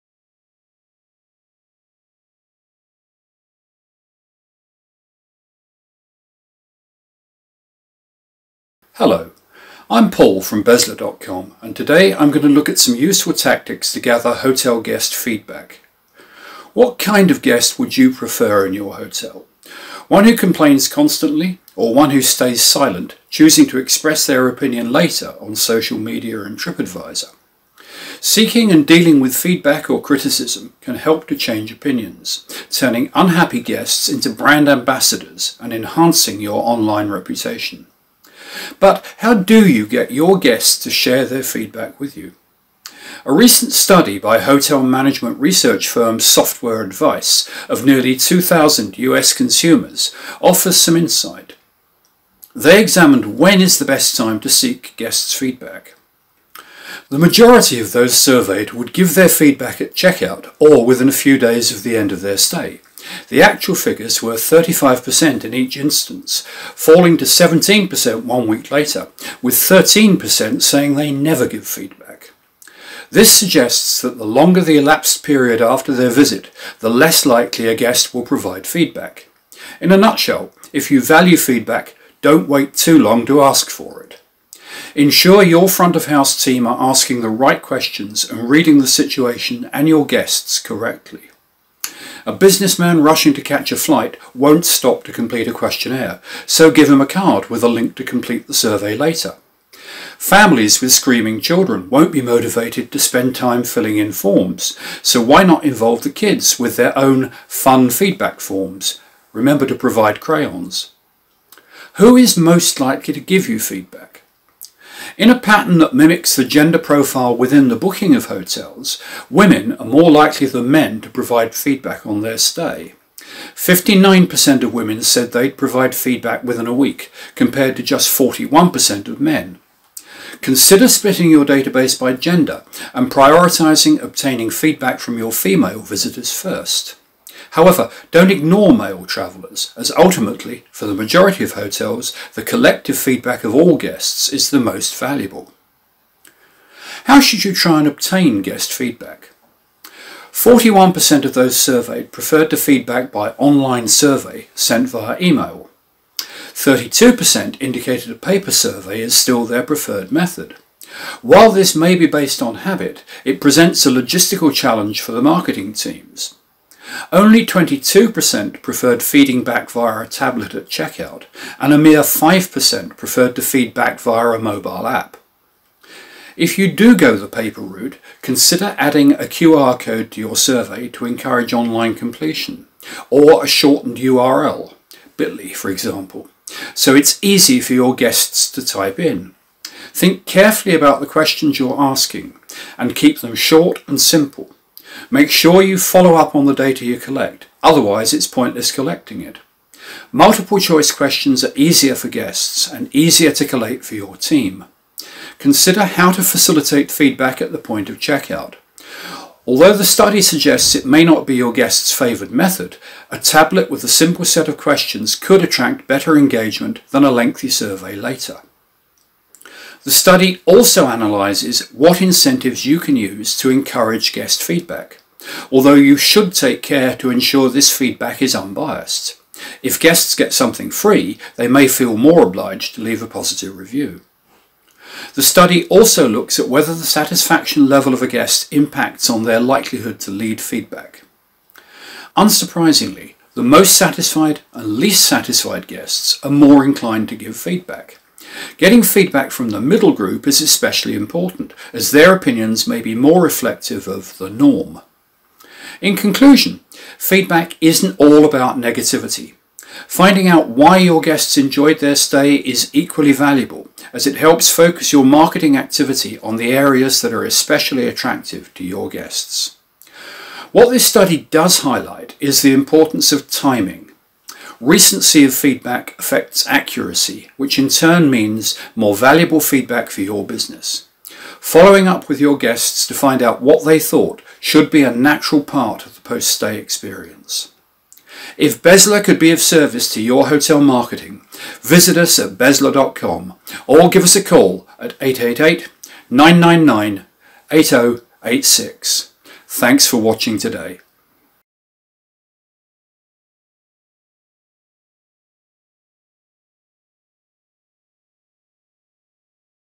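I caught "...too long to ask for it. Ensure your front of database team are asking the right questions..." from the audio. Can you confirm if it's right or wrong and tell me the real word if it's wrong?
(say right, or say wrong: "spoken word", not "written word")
wrong: "house", not "database".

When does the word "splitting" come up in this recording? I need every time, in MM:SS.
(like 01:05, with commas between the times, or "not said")
02:10.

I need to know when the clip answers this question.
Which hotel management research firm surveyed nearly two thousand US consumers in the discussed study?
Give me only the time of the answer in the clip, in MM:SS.
00:46.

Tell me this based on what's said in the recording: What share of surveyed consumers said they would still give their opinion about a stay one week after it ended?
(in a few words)
17%.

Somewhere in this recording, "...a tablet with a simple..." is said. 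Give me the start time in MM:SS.
03:33.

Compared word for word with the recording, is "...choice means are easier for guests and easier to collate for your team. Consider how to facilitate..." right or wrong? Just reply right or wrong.
wrong.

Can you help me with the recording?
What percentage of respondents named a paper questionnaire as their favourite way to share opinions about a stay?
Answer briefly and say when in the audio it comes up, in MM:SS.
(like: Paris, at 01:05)
32%, at 02:36.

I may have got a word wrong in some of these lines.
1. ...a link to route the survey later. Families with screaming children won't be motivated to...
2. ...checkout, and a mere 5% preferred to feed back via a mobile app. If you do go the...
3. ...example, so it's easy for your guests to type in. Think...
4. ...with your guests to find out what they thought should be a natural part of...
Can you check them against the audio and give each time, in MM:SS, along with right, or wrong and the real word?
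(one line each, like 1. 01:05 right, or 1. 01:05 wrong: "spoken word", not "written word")
1. 01:37 wrong: "complete", not "route"
2. 02:50 right
3. 03:05 right
4. 04:42 right.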